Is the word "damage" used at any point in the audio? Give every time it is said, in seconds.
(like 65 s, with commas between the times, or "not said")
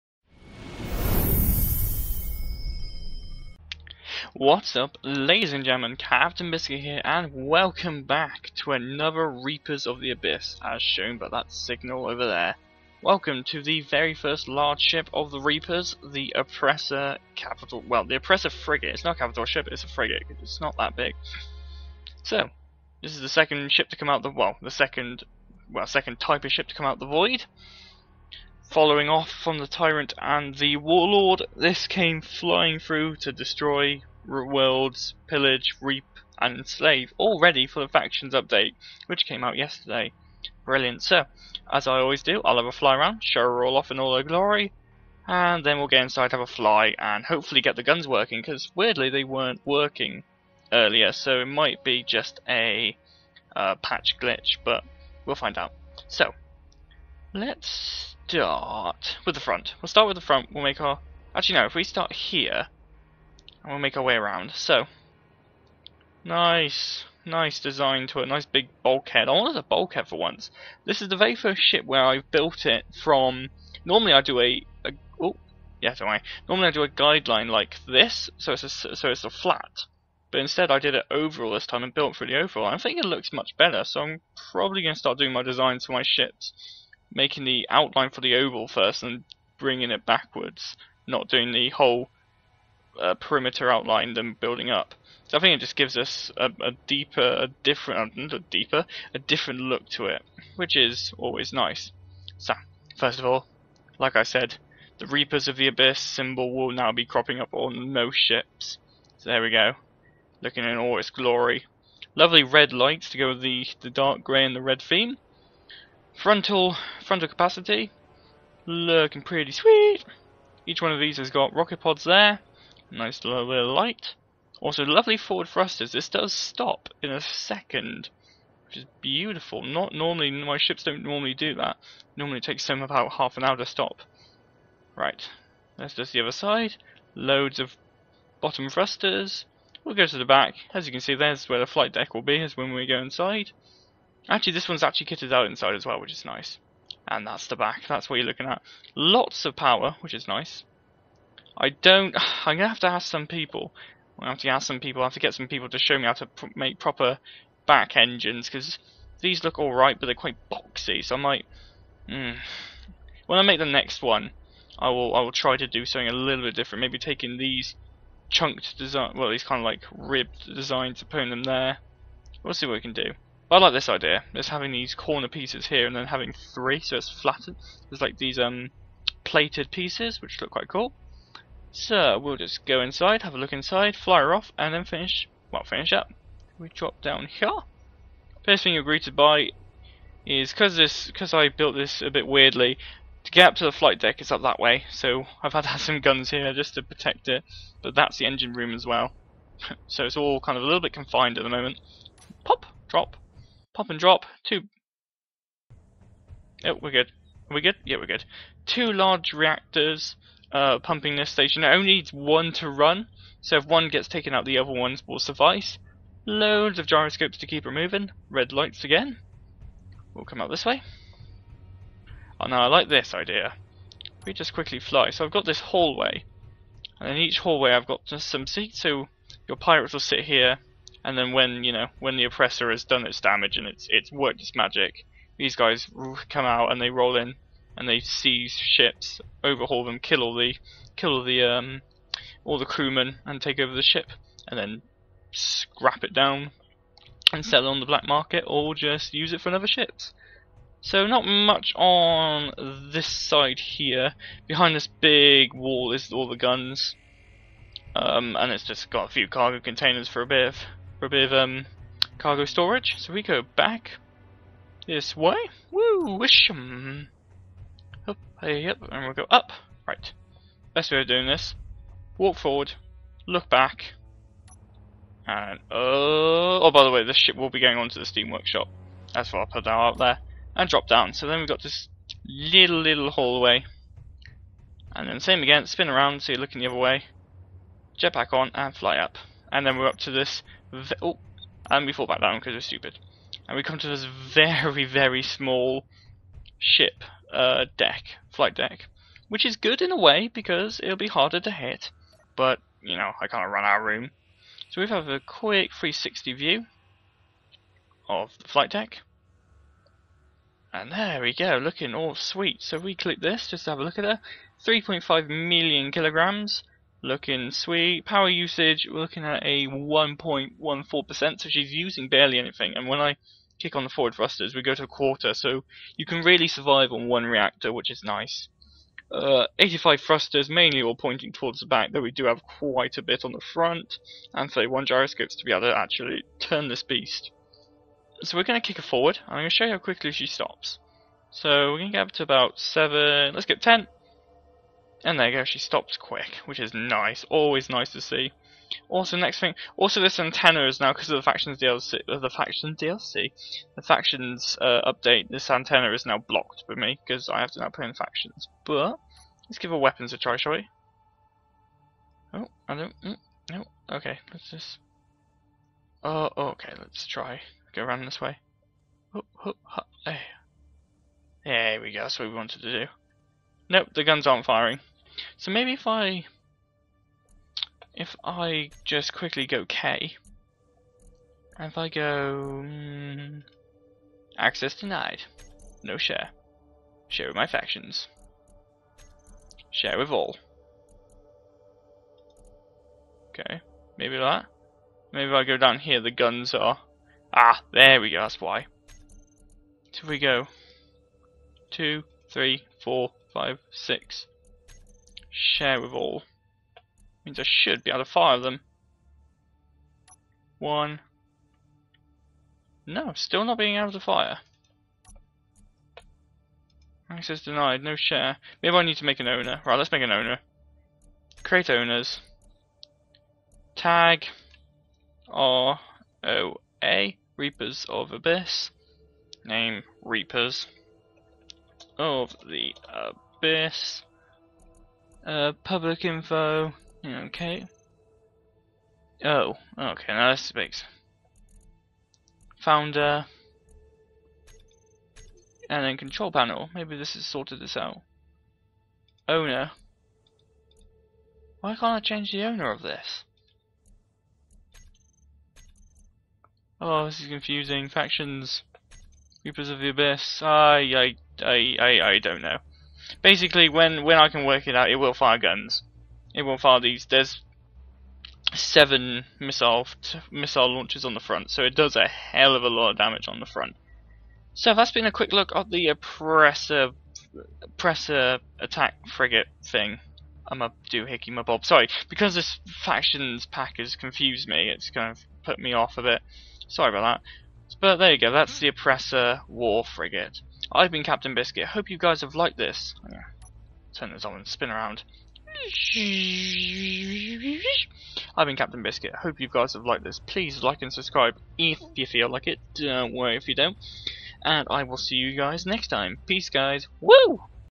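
233 s, 472 s.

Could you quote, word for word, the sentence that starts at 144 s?
Actually, this one's actually kitted out inside as well, which is nice.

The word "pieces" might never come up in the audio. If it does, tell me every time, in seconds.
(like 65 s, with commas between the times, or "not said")
175 s, 179 s.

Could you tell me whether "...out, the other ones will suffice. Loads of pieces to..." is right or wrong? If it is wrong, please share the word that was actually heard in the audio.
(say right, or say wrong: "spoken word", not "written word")
wrong: "gyroscopes", not "pieces".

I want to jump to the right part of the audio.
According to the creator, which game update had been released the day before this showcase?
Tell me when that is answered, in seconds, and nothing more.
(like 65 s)
37 s.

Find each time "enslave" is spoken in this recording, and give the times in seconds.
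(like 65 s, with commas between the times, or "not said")
36 s.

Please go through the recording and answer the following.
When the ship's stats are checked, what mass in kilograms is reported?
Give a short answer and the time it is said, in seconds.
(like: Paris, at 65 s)
3.5 million, at 314 s.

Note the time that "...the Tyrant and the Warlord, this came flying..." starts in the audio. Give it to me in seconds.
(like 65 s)
29 s.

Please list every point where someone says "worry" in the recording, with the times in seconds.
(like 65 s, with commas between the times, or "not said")
76 s, 503 s.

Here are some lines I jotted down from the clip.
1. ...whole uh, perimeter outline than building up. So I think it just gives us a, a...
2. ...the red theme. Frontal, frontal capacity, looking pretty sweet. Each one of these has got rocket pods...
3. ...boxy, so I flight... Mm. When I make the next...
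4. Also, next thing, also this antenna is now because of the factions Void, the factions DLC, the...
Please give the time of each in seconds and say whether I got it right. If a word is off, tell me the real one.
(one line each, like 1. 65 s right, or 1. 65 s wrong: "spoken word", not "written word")
1. 91 s right
2. 114 s right
3. 160 s wrong: "might", not "flight"
4. 348 s wrong: "DLC", not "Void".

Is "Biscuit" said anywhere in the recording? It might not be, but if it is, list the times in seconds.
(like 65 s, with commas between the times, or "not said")
6 s, 491 s, 498 s.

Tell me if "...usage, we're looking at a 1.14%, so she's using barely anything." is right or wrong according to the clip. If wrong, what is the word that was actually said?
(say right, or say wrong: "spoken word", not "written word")
right.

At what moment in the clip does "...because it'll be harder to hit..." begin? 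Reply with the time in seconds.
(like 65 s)
300 s.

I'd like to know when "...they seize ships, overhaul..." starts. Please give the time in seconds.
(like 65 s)
237 s.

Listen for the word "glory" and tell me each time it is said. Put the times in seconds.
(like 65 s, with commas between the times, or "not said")
44 s, 111 s.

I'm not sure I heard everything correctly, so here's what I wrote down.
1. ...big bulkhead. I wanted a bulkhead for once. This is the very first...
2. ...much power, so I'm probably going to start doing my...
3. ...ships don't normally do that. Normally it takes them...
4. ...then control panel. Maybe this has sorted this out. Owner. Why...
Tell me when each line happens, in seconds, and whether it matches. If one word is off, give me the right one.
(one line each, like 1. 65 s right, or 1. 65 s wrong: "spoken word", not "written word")
1. 68 s right
2. 83 s wrong: "better", not "power"
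3. 130 s right
4. 445 s right.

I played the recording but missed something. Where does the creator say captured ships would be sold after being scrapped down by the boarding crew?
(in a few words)
Black market.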